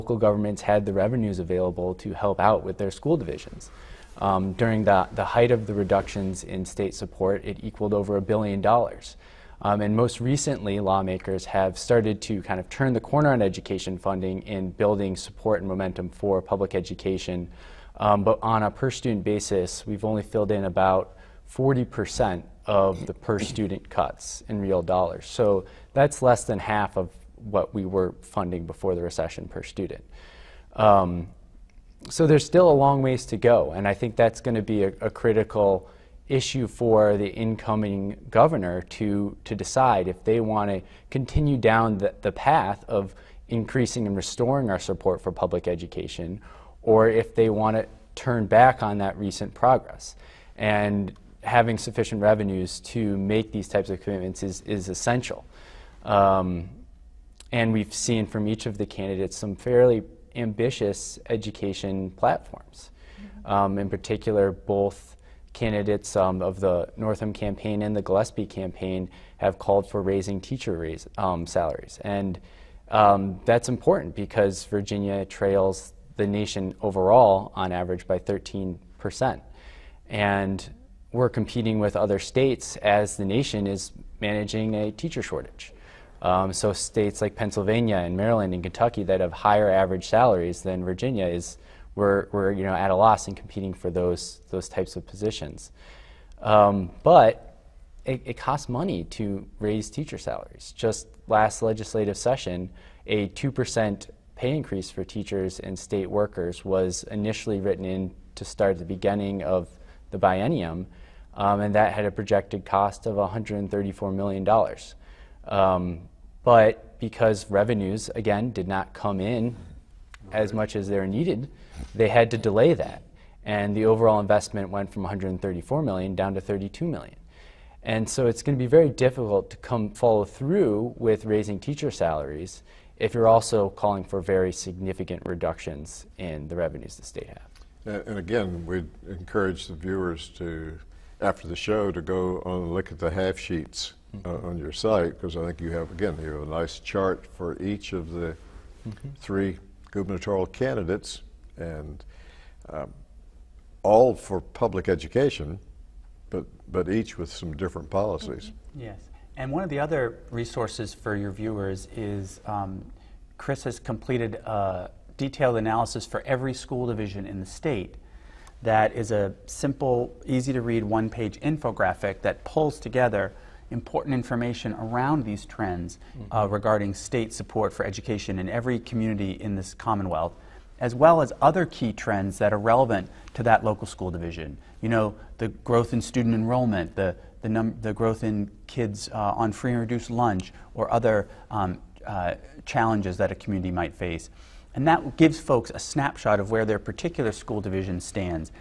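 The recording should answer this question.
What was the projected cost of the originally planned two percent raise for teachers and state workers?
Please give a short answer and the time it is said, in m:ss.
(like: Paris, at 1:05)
$134 million, at 1:53.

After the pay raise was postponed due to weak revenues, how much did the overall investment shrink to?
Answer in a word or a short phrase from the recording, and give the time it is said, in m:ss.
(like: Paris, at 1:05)
$32 million, at 2:06.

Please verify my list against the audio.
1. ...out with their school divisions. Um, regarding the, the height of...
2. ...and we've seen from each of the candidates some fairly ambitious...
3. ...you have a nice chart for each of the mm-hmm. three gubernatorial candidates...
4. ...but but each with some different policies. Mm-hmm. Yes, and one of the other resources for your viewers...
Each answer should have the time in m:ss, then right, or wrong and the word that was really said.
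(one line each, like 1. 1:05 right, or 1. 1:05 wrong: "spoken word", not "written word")
1. 0:02 wrong: "during", not "regarding"
2. 0:57 right
3. 2:26 right
4. 2:36 right.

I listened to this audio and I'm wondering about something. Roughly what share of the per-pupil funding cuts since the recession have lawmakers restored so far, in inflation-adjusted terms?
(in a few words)
40%.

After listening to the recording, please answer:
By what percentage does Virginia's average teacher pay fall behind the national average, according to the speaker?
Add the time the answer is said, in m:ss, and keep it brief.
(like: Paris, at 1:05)
13%, at 1:18.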